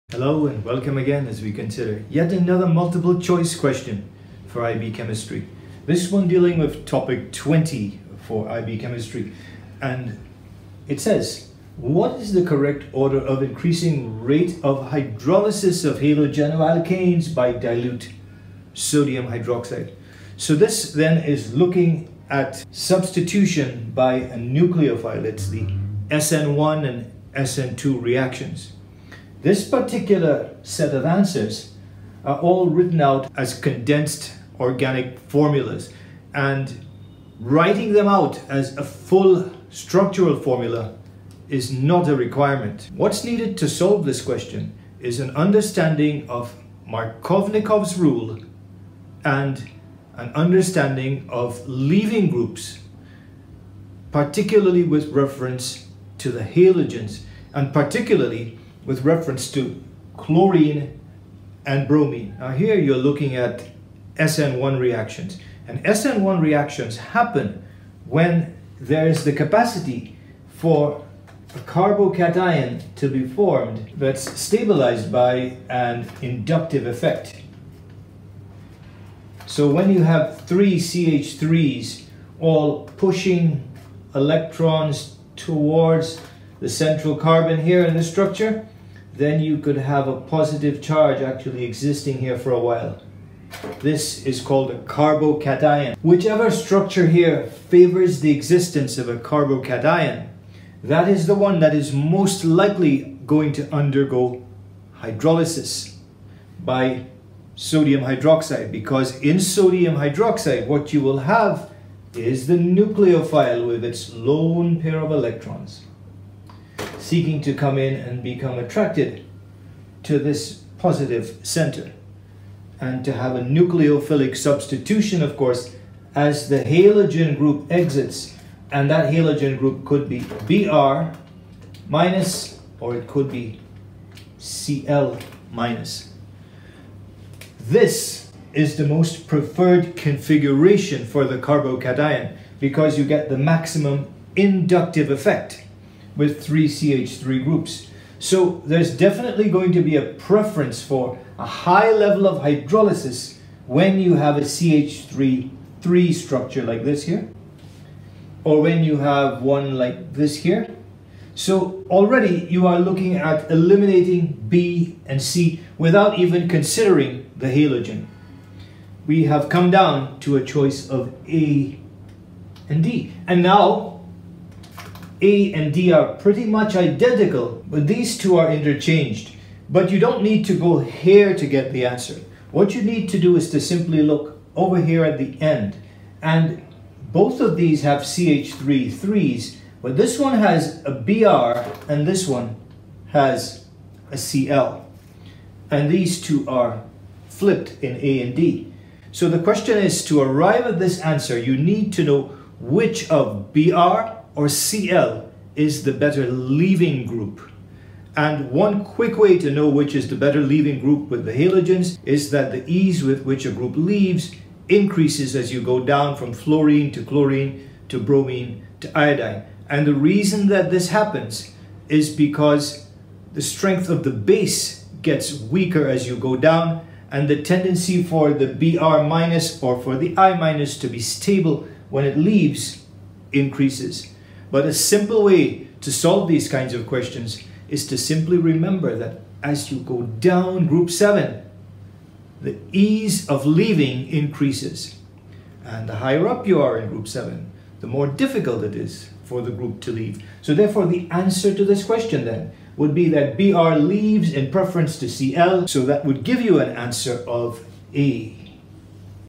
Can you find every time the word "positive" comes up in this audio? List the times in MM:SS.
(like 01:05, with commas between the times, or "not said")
01:30, 02:00.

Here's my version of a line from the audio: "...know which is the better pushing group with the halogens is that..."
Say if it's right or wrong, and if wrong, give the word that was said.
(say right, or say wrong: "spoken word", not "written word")
wrong: "leaving", not "pushing".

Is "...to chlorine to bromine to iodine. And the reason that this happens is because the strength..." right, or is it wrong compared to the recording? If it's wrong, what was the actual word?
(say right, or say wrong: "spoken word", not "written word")
right.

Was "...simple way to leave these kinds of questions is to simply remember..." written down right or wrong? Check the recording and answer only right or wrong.
wrong.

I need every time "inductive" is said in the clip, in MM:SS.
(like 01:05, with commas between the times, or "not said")
01:16, 02:24.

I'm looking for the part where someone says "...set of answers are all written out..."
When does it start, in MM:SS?
00:30.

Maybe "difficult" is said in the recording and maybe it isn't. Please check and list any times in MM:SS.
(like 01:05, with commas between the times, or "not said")
04:08.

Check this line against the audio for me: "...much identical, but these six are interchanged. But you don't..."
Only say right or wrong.
wrong.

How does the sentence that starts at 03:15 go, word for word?
And these two are flipped in A and D.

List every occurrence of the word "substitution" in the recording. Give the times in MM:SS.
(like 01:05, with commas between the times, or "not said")
00:22, 02:04.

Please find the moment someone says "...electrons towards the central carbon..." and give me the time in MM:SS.
01:24.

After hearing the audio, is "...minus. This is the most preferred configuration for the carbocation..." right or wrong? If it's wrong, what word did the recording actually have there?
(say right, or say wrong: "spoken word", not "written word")
right.